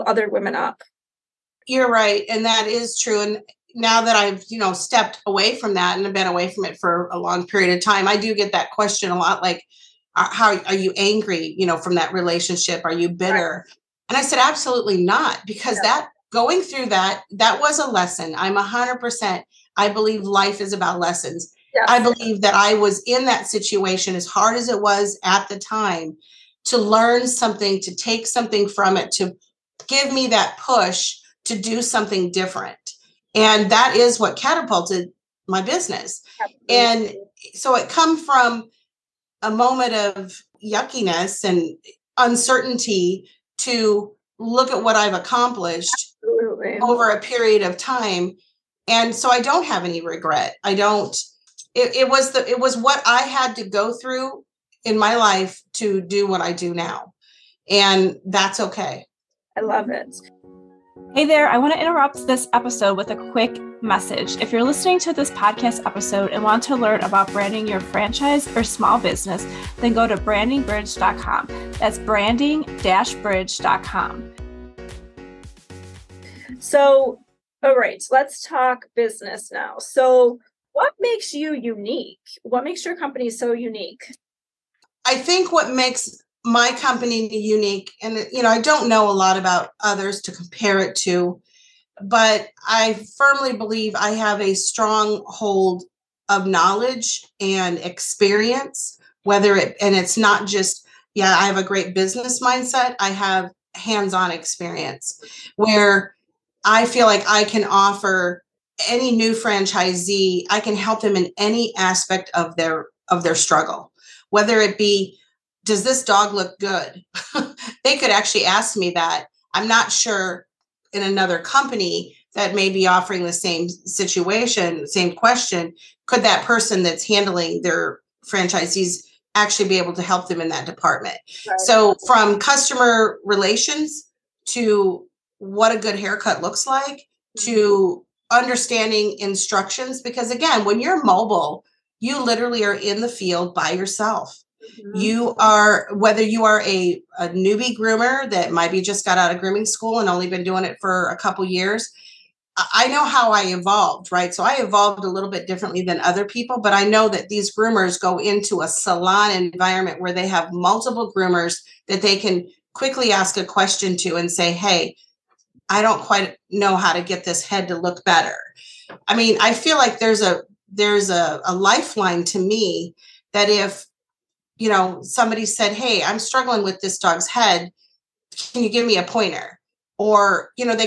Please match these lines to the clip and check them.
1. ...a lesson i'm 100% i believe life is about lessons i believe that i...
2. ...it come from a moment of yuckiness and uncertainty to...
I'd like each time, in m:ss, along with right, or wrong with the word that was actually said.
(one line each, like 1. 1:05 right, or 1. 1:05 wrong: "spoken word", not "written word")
1. 0:17 right
2. 0:37 right.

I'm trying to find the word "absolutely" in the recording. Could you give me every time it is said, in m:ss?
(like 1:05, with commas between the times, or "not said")
0:14, 0:36, 0:46.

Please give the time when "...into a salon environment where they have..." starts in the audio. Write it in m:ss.
2:38.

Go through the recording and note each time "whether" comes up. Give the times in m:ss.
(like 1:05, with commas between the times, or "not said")
1:39, 1:54, 2:25.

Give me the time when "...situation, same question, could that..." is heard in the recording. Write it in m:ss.
2:03.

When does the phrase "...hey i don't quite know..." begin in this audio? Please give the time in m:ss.
2:44.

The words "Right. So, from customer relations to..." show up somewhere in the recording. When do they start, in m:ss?
2:11.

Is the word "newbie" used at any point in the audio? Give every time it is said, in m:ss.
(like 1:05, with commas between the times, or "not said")
2:27.